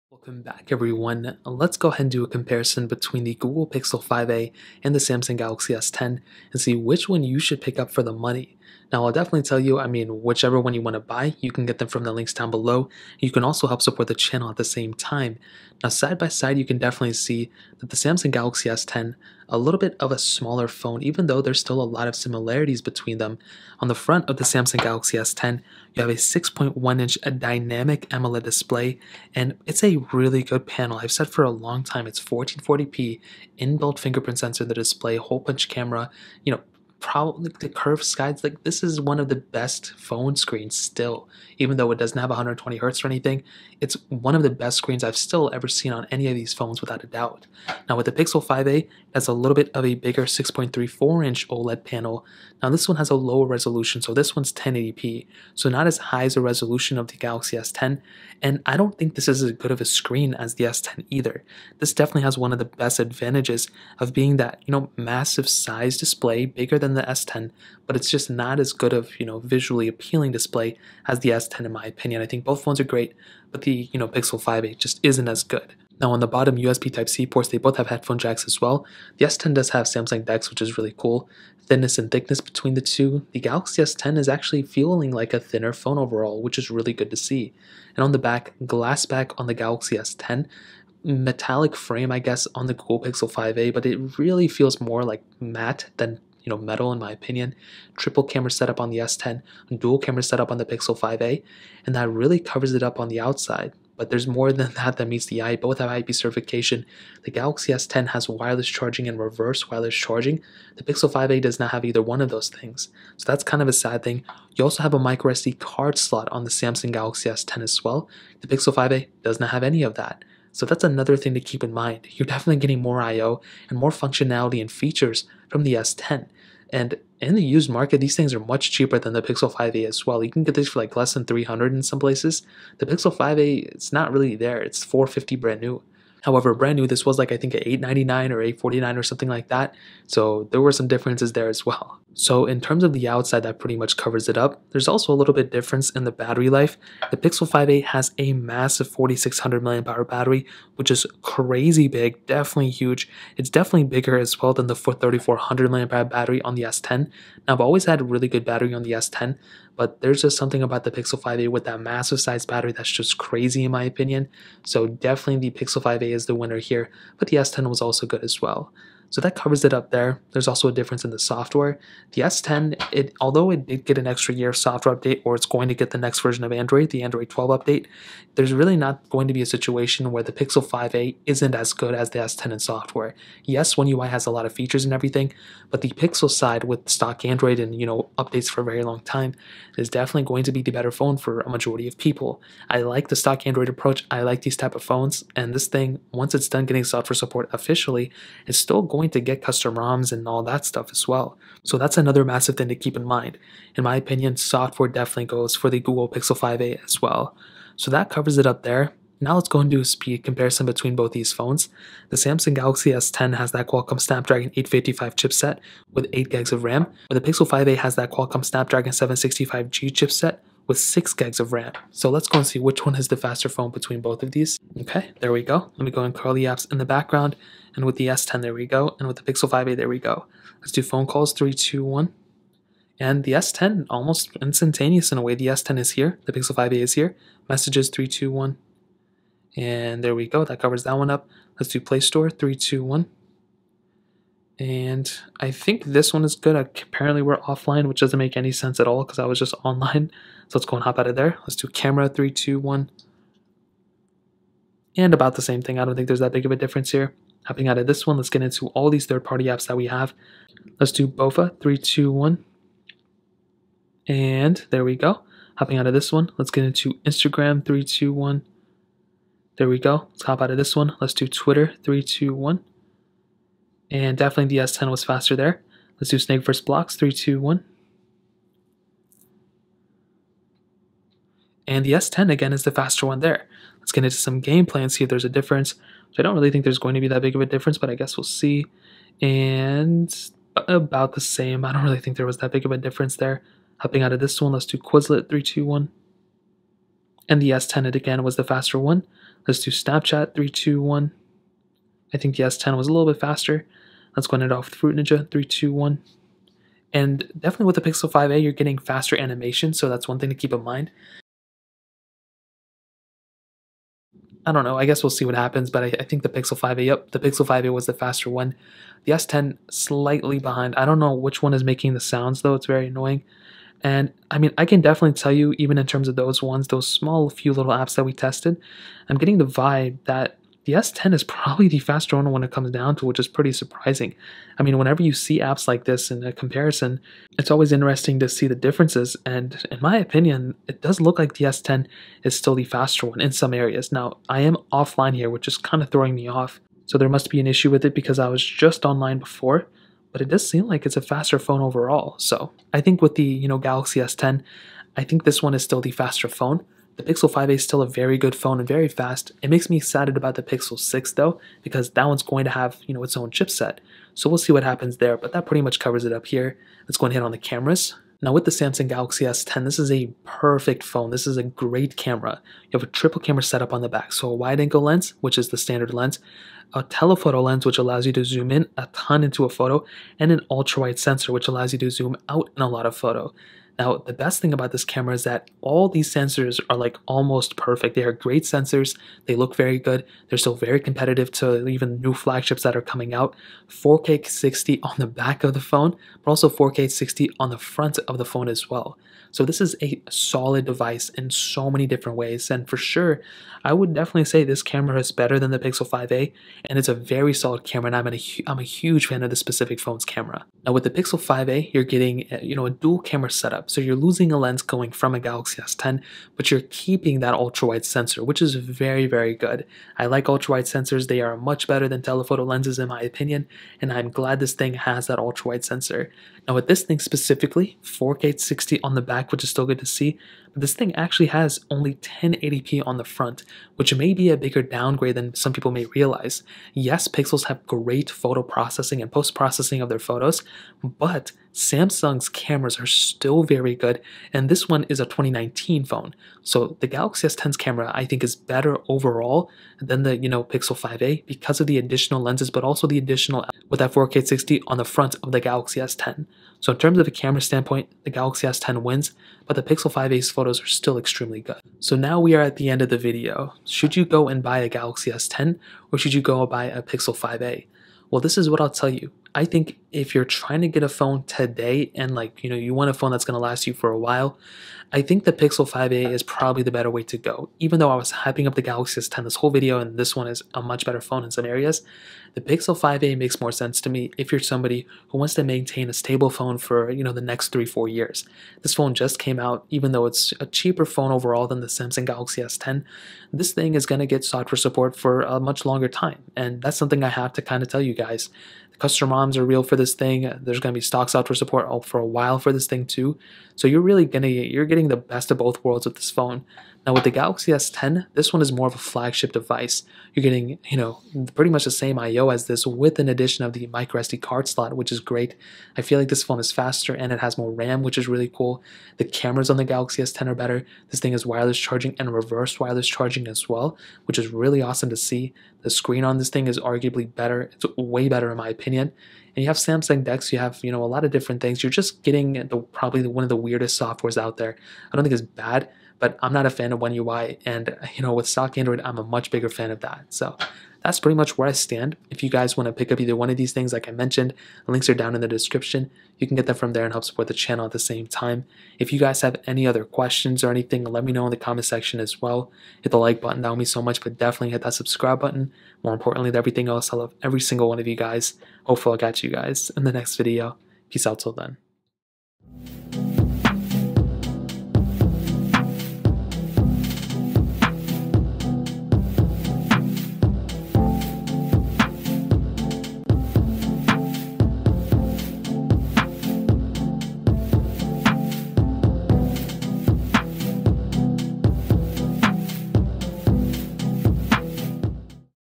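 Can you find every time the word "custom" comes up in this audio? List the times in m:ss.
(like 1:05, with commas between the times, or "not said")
3:19, 8:18.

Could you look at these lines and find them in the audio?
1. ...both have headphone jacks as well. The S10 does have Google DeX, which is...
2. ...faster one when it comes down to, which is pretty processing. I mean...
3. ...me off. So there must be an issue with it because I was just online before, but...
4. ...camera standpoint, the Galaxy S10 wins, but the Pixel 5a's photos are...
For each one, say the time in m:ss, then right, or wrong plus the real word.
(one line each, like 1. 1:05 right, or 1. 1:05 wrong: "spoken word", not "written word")
1. 1:17 wrong: "Samsung", not "Google"
2. 5:31 wrong: "surprising", not "processing"
3. 5:46 right
4. 7:37 right.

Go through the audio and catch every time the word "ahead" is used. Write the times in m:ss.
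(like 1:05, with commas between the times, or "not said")
0:01, 5:04.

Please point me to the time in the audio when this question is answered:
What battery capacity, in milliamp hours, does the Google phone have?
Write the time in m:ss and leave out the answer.
2:28.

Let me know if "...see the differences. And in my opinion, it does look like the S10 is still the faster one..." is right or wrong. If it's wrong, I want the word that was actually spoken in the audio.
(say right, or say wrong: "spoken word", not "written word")
right.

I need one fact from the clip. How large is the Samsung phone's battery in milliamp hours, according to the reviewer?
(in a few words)
3400.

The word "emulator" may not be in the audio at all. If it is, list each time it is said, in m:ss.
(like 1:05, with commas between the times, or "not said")
not said.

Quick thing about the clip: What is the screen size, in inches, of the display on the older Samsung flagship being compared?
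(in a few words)
6.1 inch.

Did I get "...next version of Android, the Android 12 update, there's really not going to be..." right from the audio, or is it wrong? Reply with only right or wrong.
right.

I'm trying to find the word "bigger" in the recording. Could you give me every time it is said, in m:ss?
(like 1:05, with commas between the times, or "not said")
0:49, 1:06, 2:33, 7:14, 8:59.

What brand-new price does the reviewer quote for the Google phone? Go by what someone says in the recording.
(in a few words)
450.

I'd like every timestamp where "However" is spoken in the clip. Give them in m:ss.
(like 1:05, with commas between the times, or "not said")
2:16.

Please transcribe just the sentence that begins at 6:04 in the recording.
So we'll see what happens there, but that pretty much covers it up here.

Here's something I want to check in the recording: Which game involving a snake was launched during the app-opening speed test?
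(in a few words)
Snake versus Blocks.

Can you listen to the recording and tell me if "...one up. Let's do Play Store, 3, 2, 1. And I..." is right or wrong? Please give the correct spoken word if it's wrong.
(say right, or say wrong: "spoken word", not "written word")
right.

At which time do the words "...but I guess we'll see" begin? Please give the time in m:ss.
4:47.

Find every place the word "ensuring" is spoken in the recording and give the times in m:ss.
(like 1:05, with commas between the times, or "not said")
not said.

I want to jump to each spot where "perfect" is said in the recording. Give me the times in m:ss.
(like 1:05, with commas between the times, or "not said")
6:10, 6:27.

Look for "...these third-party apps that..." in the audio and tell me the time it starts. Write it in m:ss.
4:18.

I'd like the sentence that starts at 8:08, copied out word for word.
This phone just came out even though it's a cheaper phone overall than the Samsung Galaxy S10.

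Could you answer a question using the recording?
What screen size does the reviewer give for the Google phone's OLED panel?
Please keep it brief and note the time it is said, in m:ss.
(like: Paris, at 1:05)
6.34 inch, at 0:50.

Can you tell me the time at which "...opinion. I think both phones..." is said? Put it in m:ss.
1:11.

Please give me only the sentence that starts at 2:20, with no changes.
So there were some differences there as well.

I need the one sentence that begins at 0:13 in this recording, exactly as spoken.
You can also help support the channel at the same time.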